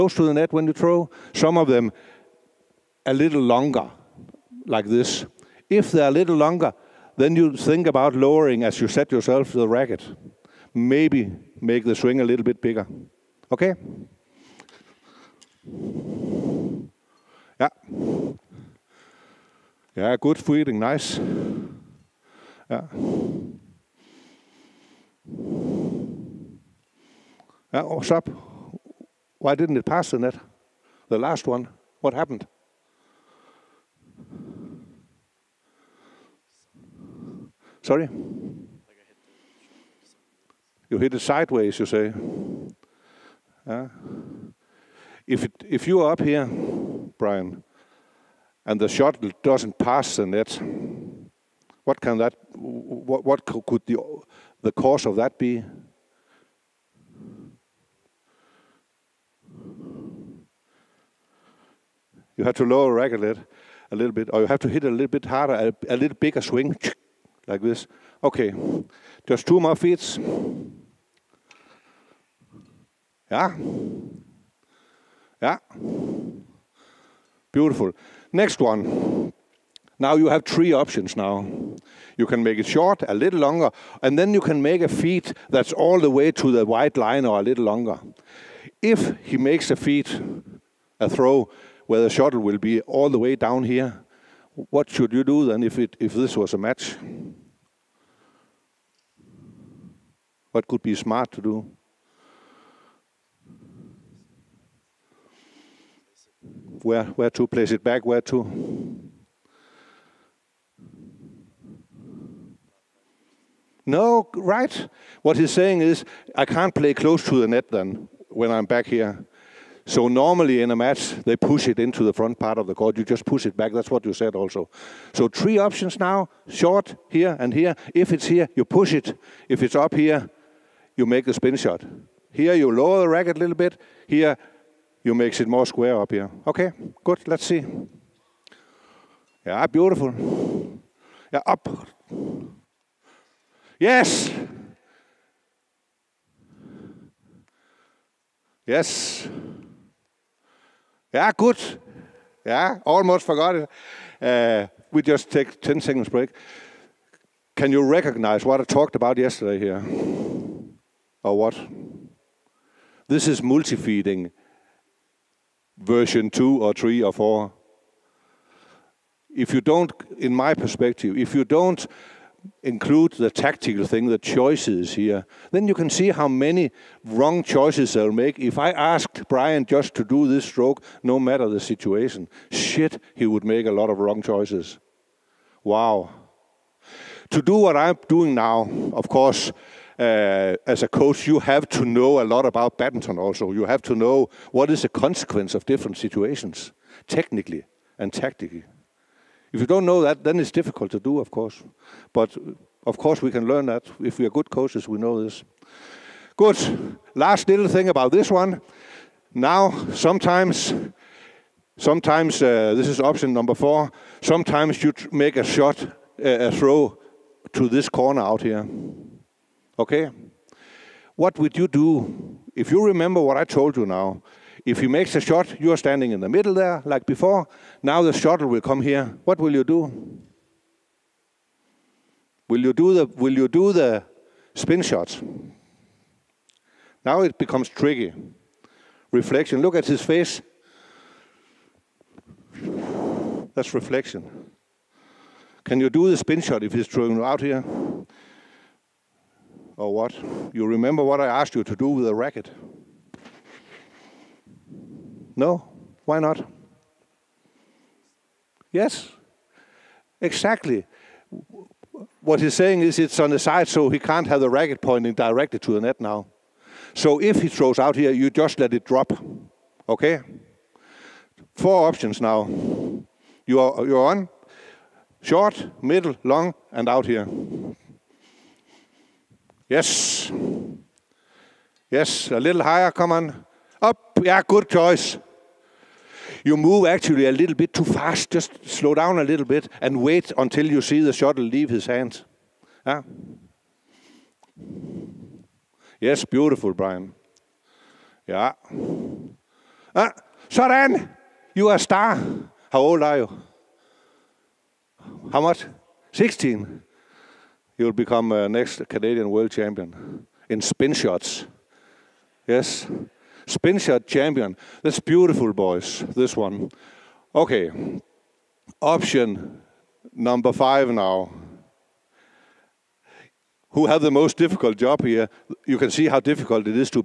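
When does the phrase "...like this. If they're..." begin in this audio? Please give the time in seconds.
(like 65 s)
4 s.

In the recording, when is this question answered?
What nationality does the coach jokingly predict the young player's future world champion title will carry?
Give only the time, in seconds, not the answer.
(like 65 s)
308 s.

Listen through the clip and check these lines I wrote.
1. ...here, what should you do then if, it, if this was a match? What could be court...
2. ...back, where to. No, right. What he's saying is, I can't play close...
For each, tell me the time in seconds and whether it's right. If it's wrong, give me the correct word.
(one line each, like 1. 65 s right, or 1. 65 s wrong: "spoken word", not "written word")
1. 93 s wrong: "smart", not "court"
2. 107 s right.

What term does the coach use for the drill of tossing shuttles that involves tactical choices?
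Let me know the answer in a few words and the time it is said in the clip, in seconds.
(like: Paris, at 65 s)
multi-feeding, at 163 s.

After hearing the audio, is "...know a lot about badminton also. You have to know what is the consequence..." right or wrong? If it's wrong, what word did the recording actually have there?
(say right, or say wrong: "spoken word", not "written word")
right.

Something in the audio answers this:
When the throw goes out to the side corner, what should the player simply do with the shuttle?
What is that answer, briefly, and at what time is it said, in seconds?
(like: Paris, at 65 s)
let it drop, at 268 s.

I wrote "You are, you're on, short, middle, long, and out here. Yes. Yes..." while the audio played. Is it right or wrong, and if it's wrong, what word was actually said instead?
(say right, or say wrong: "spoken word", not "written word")
right.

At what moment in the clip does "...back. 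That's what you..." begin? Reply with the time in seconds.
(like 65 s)
123 s.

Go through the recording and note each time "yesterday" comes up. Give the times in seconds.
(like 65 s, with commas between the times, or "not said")
159 s.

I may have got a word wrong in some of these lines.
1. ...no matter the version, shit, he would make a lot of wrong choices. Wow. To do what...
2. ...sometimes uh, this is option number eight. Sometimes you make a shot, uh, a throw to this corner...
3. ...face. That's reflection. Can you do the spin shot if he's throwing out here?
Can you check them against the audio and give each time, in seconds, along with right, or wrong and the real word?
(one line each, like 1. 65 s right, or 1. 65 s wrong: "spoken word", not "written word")
1. 181 s wrong: "situation", not "version"
2. 211 s wrong: "four", not "eight"
3. 240 s right.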